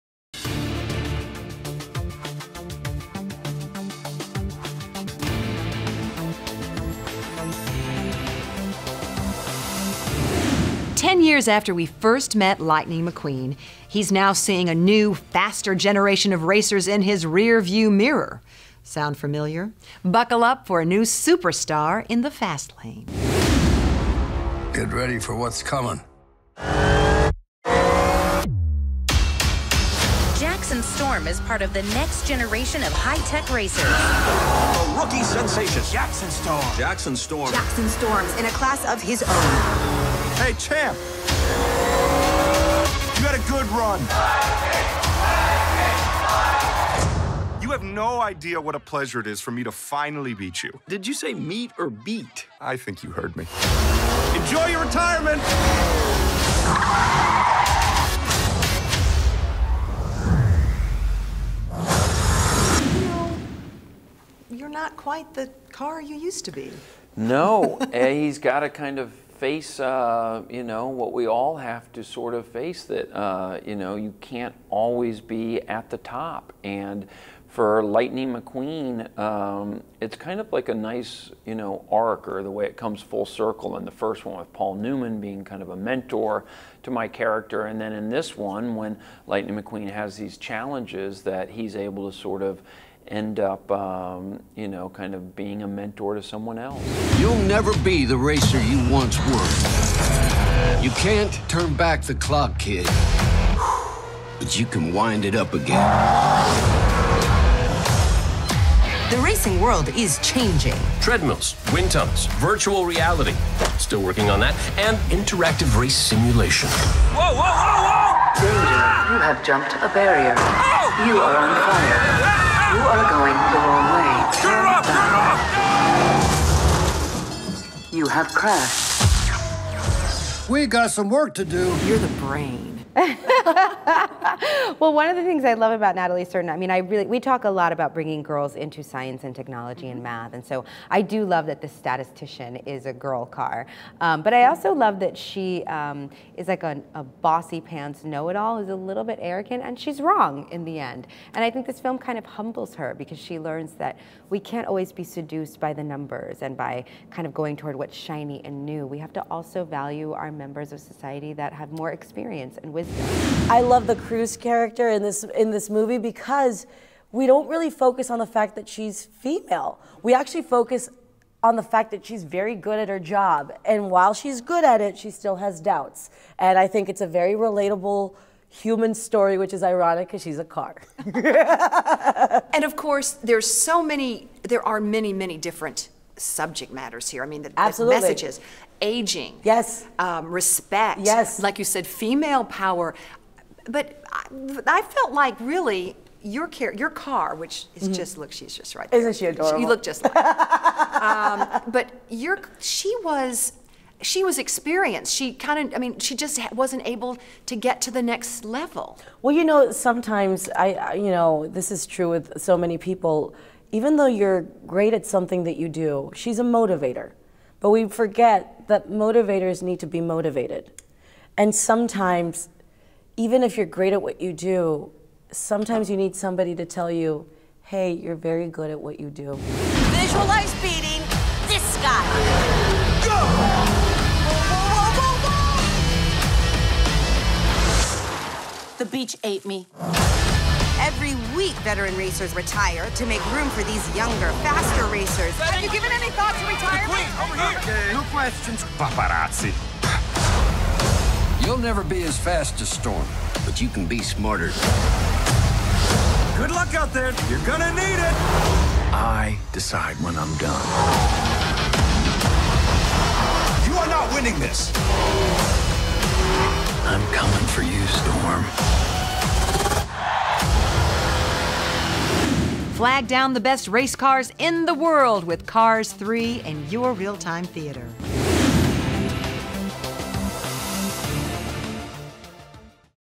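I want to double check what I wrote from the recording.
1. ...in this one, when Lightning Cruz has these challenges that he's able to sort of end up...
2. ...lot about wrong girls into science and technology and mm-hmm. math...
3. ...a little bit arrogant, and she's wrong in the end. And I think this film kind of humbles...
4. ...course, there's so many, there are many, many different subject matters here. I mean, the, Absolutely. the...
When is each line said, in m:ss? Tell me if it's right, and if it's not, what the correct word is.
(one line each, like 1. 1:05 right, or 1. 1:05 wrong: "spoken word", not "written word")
1. 1:27 wrong: "McQueen", not "Cruz"
2. 2:17 wrong: "bringing", not "wrong"
3. 2:28 right
4. 3:02 right.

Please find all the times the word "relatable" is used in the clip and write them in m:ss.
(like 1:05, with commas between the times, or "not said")
2:57.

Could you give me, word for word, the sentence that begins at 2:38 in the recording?
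We have to also value our members of society that have more experience and wisdom wisdom.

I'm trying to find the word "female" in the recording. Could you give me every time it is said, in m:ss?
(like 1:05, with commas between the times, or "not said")
2:49, 3:11.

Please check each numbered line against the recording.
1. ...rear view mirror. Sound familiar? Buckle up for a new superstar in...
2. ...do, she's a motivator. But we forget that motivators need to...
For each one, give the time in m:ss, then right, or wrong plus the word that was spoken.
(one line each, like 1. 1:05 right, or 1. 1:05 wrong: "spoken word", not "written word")
1. 0:17 right
2. 3:35 right.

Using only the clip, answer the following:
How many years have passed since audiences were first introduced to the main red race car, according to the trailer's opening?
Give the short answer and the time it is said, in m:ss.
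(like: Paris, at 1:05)
10, at 0:11.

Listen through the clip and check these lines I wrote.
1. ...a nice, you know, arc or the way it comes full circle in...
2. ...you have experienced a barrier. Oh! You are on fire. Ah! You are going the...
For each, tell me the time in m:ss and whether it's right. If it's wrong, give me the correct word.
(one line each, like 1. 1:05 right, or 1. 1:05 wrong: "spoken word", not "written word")
1. 1:20 right
2. 1:59 wrong: "jumped", not "experienced".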